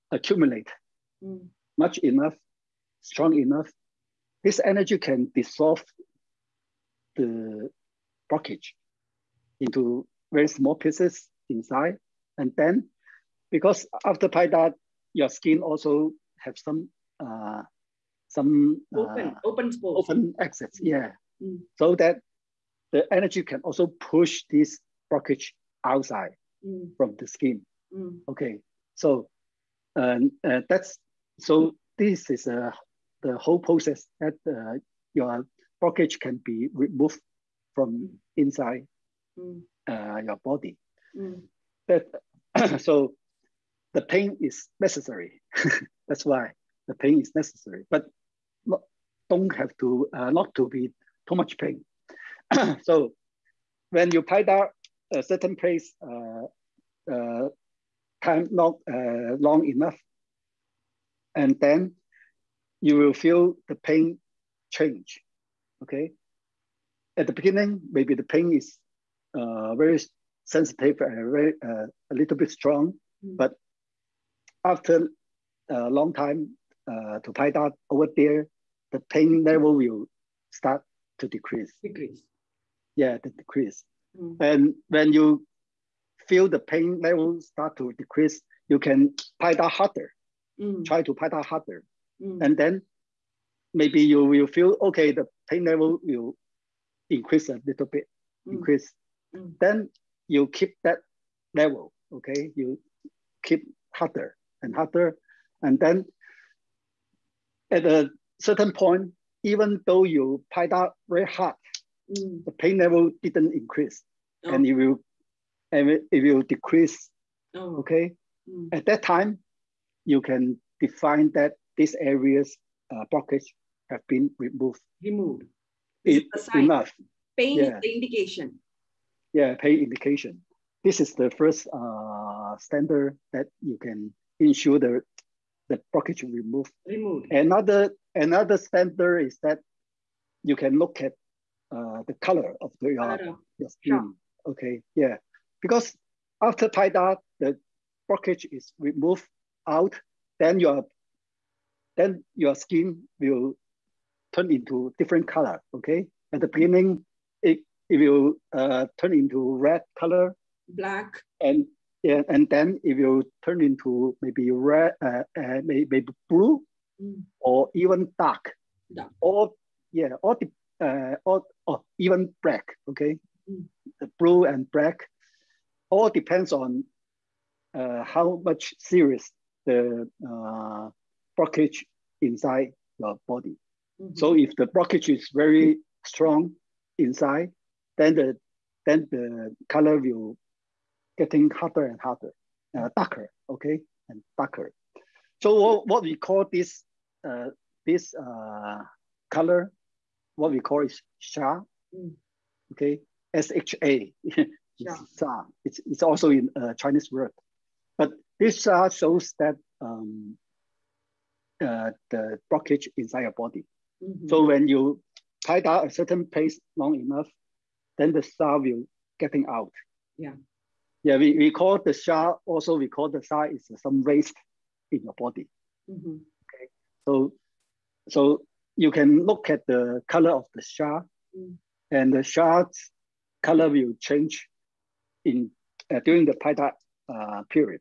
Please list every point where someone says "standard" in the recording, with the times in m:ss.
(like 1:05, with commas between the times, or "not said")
2:12, 2:18.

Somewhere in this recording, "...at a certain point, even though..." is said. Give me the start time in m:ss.
1:47.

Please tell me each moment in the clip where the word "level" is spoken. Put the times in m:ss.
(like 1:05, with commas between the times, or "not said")
1:19, 1:27, 1:35, 1:41, 1:52.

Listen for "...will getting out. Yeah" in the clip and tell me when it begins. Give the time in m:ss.
3:38.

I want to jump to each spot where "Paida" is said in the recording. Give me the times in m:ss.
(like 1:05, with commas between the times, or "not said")
0:14, 3:56.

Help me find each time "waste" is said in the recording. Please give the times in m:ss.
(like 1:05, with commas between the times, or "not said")
3:44.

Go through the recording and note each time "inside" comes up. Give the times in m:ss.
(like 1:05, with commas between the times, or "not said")
0:11, 0:38, 3:02, 3:06, 3:32.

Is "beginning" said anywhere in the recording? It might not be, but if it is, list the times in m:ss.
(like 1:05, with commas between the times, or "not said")
1:07, 2:36.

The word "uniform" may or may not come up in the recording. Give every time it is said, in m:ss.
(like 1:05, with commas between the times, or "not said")
not said.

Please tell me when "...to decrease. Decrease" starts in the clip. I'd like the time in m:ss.
1:21.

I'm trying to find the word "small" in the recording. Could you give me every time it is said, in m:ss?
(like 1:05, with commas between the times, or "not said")
0:10.